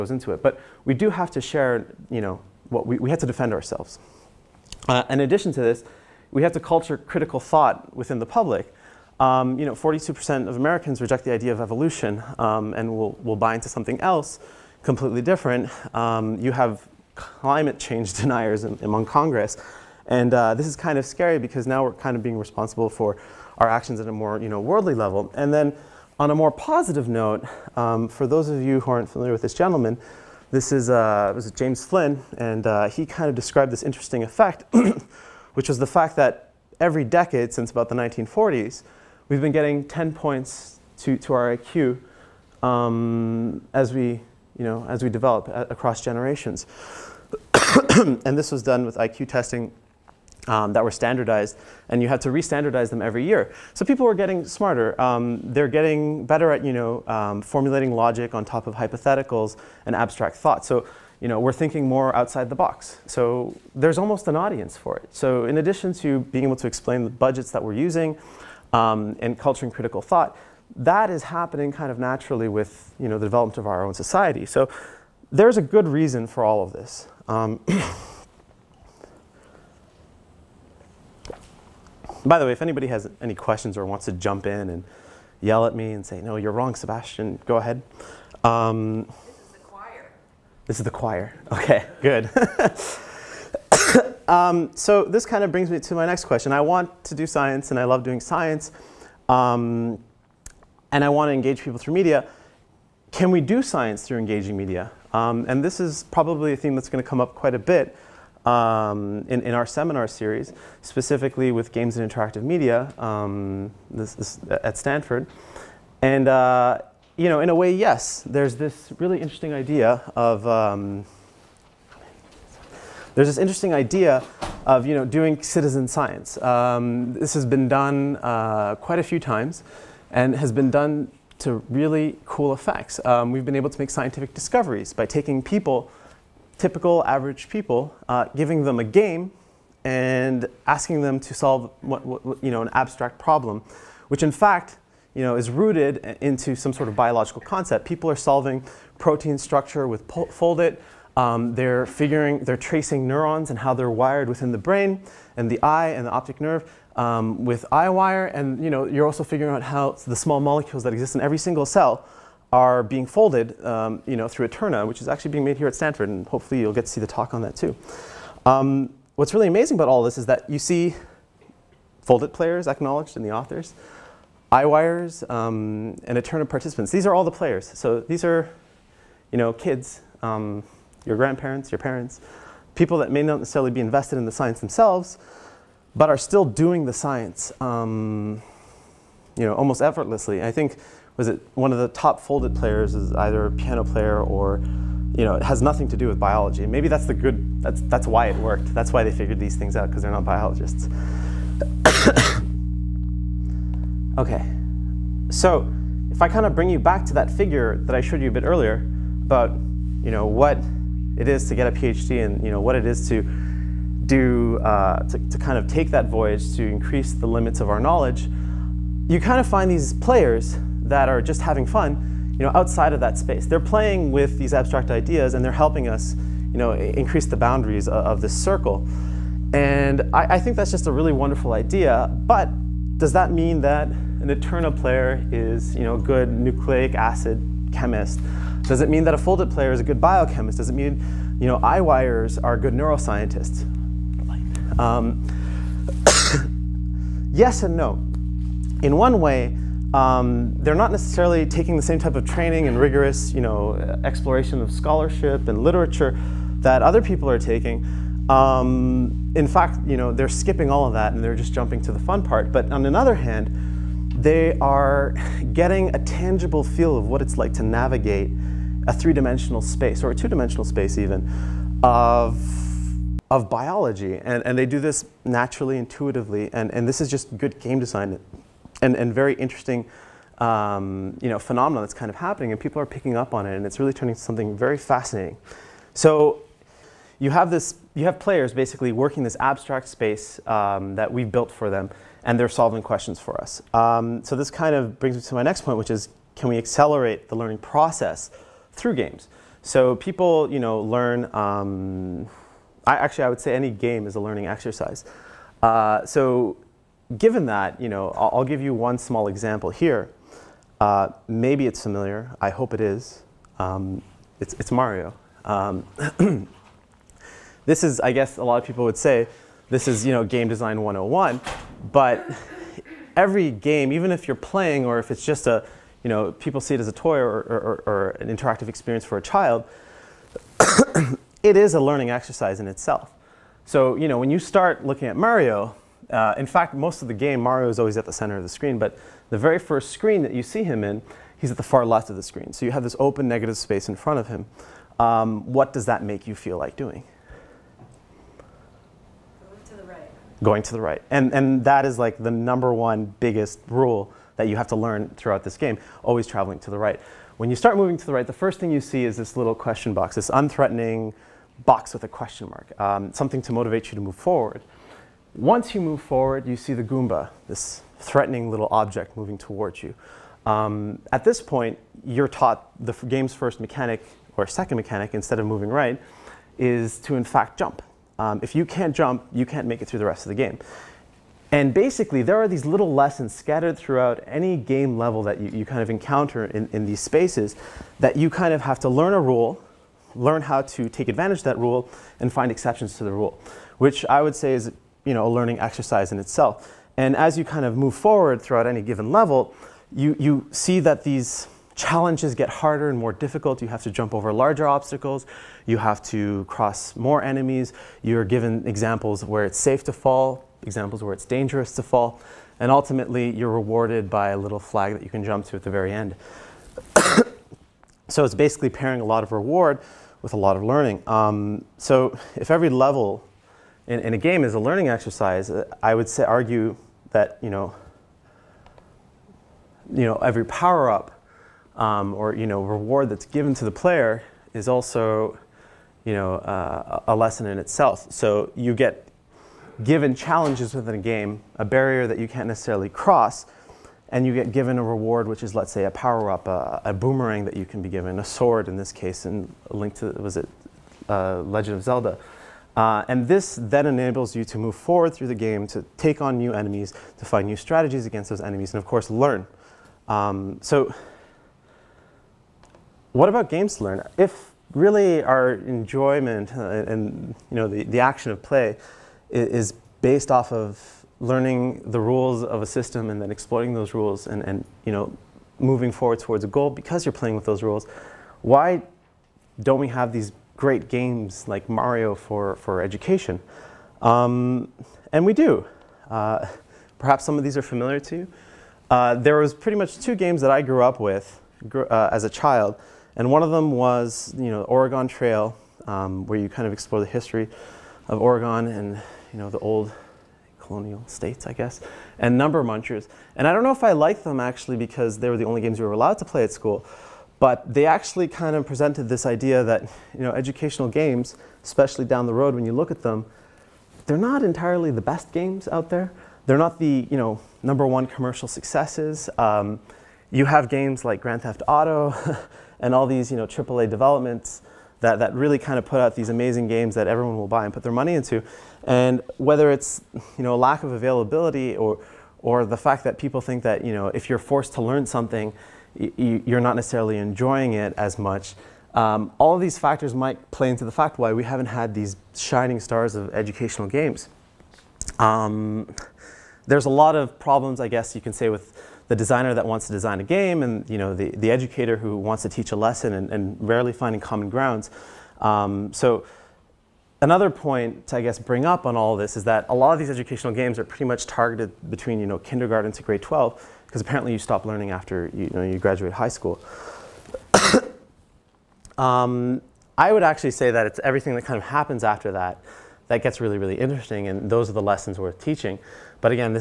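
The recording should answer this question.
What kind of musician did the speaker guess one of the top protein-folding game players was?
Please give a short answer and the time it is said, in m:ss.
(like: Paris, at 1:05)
piano player, at 3:13.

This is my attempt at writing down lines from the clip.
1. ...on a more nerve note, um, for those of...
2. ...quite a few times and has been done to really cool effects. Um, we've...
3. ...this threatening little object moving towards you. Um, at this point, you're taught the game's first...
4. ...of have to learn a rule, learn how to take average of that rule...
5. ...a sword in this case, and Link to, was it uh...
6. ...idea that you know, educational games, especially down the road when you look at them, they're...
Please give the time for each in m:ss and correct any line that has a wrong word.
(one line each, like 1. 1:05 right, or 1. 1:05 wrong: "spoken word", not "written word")
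1. 0:26 wrong: "positive", not "nerve"
2. 2:08 right
3. 6:07 right
4. 6:28 wrong: "advantage", not "average"
5. 7:28 right
6. 8:29 right.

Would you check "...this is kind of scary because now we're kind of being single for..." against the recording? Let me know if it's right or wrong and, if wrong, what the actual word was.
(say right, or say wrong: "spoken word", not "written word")
wrong: "responsible", not "single".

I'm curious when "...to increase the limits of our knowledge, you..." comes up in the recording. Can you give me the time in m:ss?
3:36.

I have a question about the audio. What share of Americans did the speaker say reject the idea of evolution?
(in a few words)
42%.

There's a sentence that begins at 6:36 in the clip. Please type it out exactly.
And as you kind of move forward throughout any given level, you, you see that these challenges get harder and more difficult.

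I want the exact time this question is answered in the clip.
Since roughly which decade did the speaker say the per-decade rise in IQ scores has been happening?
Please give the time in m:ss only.
0:37.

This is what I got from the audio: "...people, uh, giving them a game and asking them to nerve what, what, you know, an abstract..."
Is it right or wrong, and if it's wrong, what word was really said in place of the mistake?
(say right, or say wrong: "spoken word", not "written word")
wrong: "solve", not "nerve".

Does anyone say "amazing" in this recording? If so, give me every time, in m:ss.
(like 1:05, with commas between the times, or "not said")
2:49, 8:46.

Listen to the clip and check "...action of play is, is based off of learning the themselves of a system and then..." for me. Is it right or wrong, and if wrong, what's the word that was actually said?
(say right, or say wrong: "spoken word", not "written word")
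wrong: "rules", not "themselves".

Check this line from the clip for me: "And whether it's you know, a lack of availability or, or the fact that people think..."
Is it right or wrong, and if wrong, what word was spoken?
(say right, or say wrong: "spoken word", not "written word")
right.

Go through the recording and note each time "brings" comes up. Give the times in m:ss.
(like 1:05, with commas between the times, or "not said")
1:35, 3:26, 4:55, 9:18.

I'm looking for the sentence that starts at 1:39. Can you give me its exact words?
Um, and I want to engage people through media.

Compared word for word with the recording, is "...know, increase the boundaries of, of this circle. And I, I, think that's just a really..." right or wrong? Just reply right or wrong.
right.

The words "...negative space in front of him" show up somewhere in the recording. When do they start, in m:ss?
5:43.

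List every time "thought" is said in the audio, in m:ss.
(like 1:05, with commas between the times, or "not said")
0:07, 1:00, 1:10.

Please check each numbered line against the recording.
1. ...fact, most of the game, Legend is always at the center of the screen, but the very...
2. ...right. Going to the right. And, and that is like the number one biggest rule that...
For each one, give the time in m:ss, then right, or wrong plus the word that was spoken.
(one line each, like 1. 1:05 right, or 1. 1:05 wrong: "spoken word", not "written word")
1. 5:36 wrong: "Mario", not "Legend"
2. 5:49 right.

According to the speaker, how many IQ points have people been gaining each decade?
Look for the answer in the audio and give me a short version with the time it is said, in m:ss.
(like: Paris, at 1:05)
10, at 0:39.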